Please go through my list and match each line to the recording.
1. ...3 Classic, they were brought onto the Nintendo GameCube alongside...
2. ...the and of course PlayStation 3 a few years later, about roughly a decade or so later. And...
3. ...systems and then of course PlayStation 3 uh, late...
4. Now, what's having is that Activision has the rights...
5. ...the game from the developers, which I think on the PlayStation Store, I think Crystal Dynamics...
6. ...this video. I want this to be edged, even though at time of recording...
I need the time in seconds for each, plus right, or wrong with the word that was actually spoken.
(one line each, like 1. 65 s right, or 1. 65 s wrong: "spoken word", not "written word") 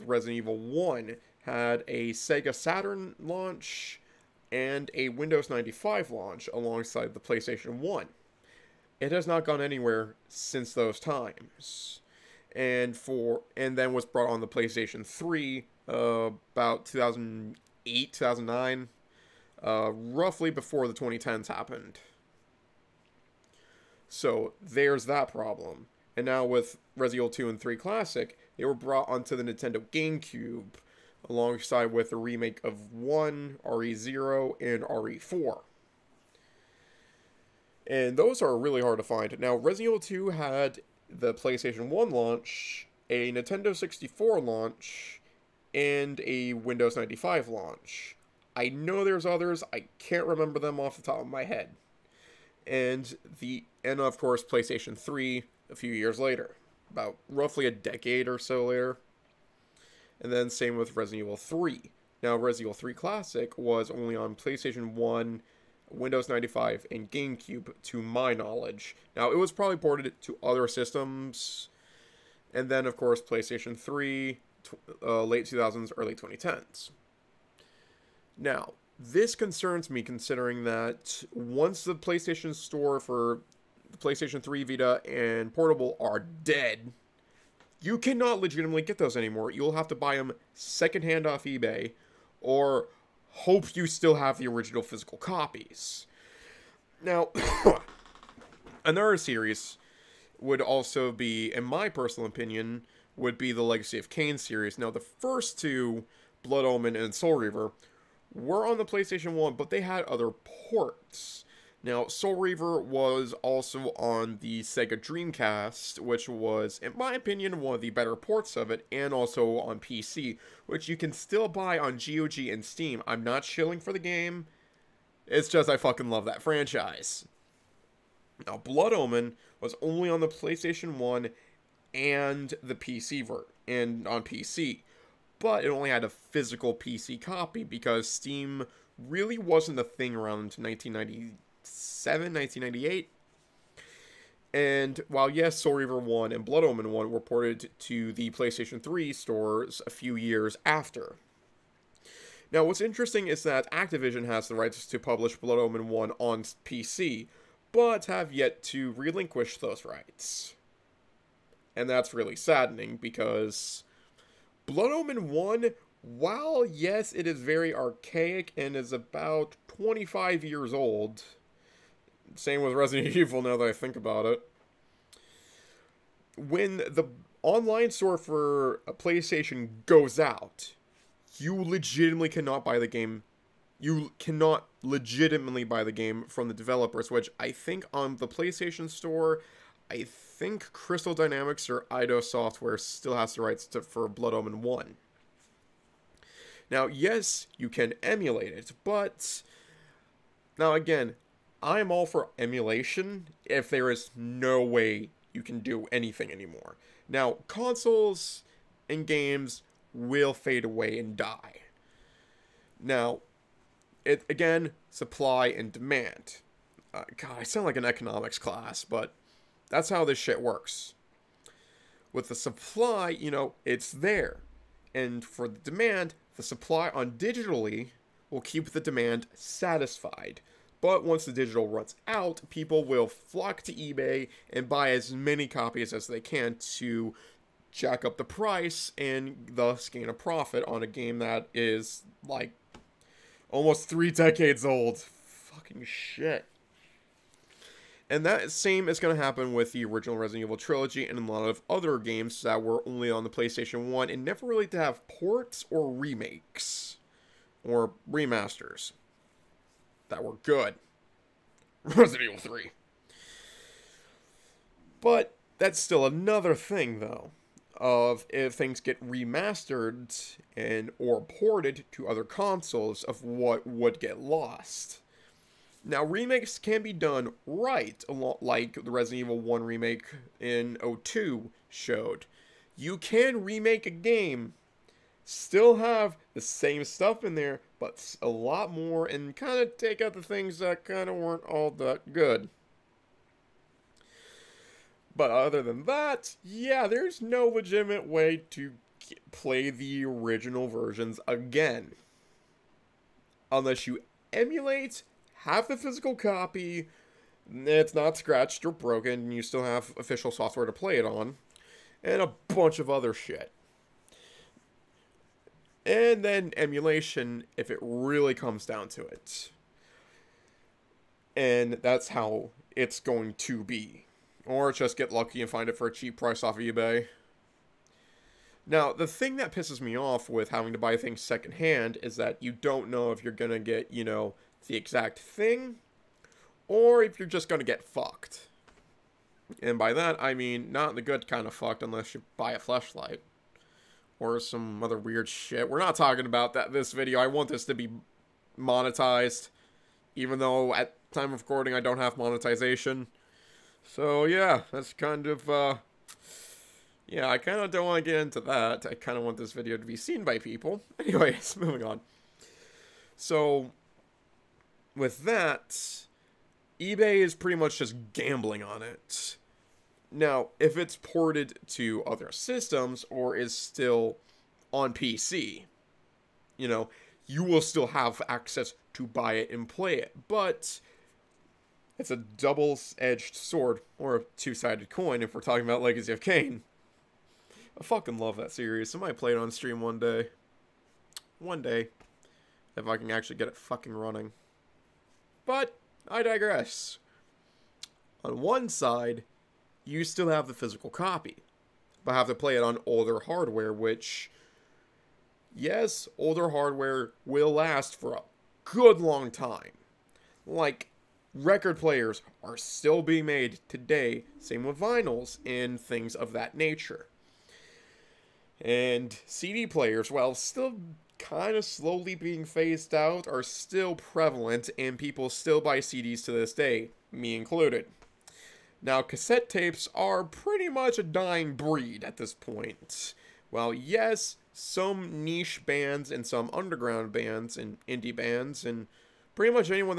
1. 27 s right
2. 53 s right
3. 70 s right
4. 152 s wrong: "interesting", not "having"
5. 185 s right
6. 346 s wrong: "monetized", not "edged".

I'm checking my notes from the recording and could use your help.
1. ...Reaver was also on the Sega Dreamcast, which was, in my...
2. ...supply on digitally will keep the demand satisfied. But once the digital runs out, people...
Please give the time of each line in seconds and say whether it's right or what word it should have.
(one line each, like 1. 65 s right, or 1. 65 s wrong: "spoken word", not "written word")
1. 112 s right
2. 226 s right.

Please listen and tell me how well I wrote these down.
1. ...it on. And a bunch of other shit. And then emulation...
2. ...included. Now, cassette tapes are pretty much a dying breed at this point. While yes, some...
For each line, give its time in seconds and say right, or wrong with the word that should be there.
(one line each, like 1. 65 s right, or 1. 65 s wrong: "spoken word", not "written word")
1. 310 s right
2. 427 s right.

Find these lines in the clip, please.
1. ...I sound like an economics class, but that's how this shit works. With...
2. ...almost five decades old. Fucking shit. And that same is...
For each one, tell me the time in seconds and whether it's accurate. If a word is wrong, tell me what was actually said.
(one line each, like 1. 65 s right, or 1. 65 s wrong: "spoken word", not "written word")
1. 217 s right
2. 243 s wrong: "three", not "five".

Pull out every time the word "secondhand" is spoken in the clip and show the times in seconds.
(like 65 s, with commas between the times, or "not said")
90 s, 331 s.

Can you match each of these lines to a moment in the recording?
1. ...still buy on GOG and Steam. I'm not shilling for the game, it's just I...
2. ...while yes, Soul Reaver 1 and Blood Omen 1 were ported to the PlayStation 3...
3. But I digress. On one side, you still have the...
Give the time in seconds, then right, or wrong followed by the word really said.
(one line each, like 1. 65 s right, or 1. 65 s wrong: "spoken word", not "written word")
1. 121 s right
2. 145 s right
3. 395 s right.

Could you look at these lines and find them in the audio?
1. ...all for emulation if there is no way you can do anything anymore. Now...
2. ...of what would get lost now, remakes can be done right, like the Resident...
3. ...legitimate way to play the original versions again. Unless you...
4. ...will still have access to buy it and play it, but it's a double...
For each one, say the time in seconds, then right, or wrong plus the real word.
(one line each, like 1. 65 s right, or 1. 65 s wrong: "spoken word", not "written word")
1. 201 s right
2. 273 s right
3. 297 s right
4. 377 s right.